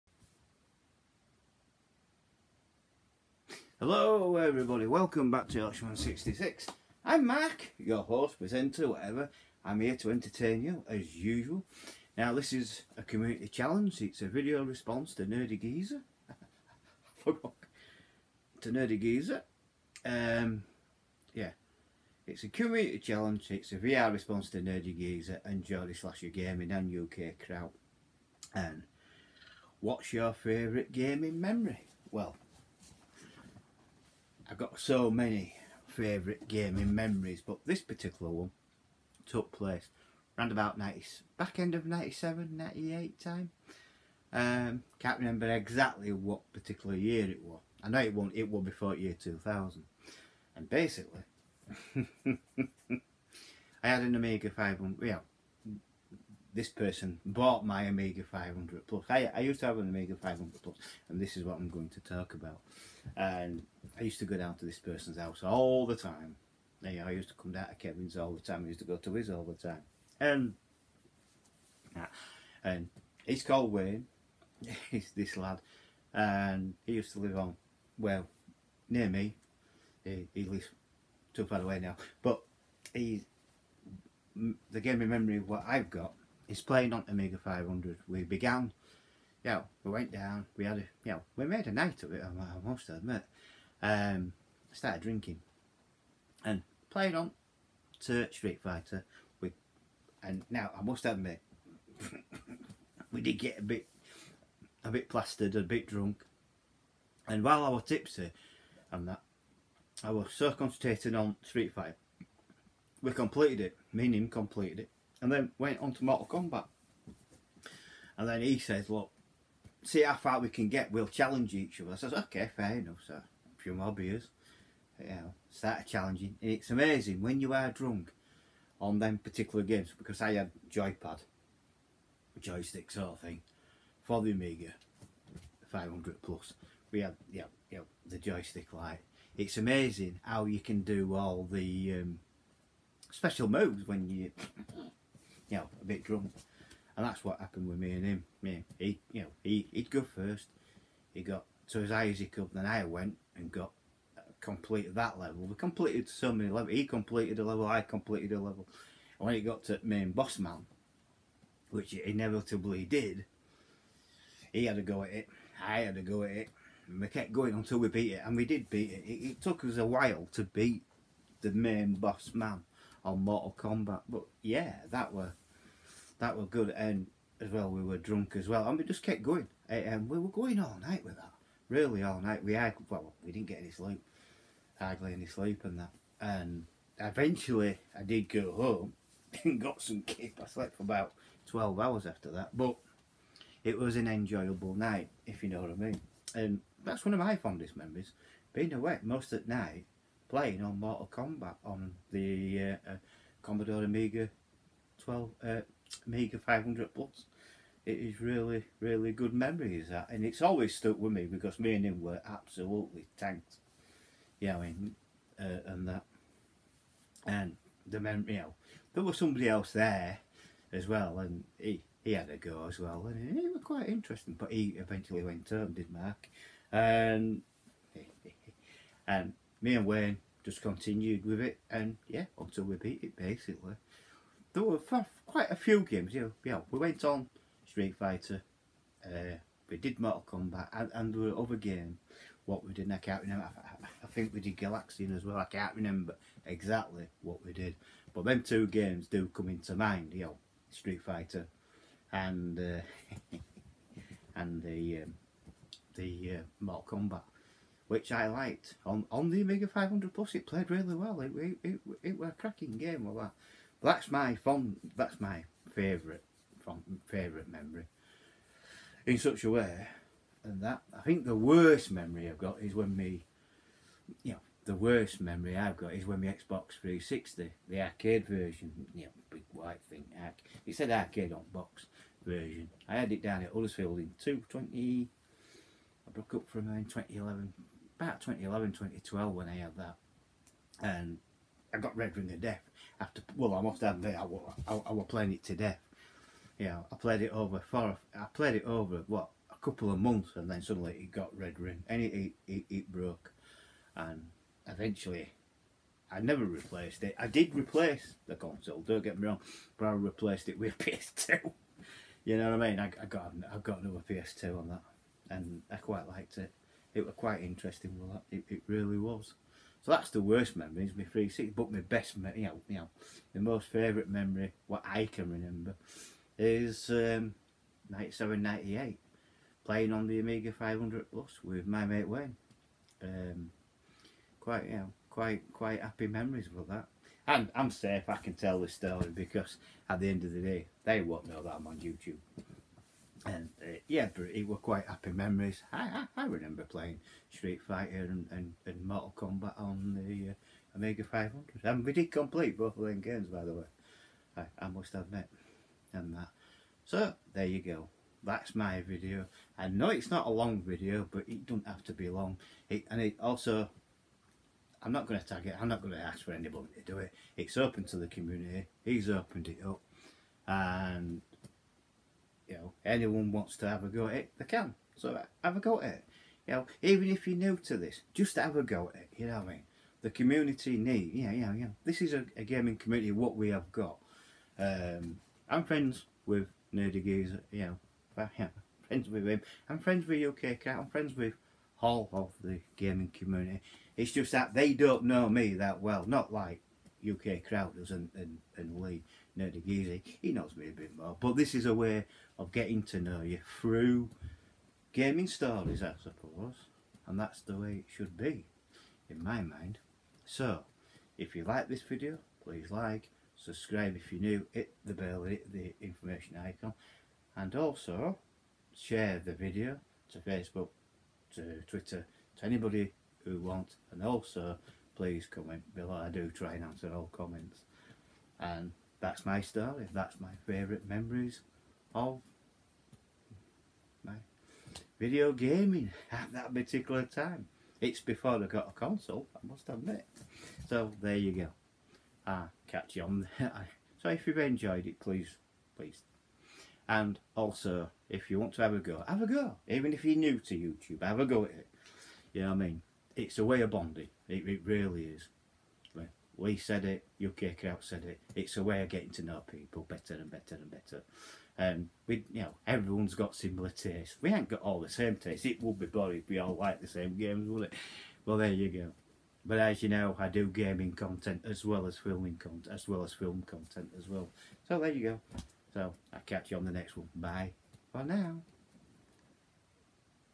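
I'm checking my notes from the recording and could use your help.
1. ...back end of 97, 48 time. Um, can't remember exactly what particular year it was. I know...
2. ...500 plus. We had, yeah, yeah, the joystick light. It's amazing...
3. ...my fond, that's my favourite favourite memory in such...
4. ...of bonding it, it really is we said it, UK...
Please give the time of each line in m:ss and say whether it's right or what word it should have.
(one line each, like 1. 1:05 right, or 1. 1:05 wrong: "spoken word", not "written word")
1. 0:41 wrong: "98", not "48"
2. 2:15 right
3. 4:24 right
4. 7:33 right.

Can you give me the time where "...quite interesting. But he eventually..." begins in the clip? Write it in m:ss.
3:43.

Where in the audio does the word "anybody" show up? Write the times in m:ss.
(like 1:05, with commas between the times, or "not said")
6:06, 7:02.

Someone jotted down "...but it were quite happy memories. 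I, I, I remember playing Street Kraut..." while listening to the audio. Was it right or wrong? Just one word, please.
wrong.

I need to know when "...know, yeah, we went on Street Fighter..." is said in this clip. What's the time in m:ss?
3:56.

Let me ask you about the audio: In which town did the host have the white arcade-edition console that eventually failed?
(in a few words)
Huddersfield.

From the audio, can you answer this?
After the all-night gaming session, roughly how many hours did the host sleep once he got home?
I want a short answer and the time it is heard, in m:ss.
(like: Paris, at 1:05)
12 hours, at 3:10.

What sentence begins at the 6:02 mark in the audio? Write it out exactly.
It, and it also, I'm not going to tag it.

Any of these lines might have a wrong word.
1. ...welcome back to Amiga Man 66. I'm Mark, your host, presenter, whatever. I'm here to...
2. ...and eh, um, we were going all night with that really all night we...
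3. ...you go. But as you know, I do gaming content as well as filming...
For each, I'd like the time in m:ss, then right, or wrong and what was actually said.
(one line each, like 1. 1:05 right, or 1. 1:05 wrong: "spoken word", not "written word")
1. 0:04 wrong: "Yorkshire", not "Amiga"
2. 2:59 right
3. 7:48 right.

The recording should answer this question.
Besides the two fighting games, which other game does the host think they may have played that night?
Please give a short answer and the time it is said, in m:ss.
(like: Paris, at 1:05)
Galaxian, at 4:04.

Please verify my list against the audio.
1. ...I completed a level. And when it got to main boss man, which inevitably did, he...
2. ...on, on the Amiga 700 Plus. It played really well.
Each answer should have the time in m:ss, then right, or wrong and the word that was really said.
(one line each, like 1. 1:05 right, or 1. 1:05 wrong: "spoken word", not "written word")
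1. 2:37 right
2. 4:18 wrong: "500", not "700".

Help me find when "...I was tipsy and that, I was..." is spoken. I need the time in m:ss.
1:47.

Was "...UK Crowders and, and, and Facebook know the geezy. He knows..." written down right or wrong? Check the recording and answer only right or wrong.
wrong.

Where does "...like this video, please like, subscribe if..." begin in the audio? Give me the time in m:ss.
6:51.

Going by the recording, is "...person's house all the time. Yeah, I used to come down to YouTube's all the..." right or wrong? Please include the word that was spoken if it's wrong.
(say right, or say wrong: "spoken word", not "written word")
wrong: "Kevin", not "YouTube".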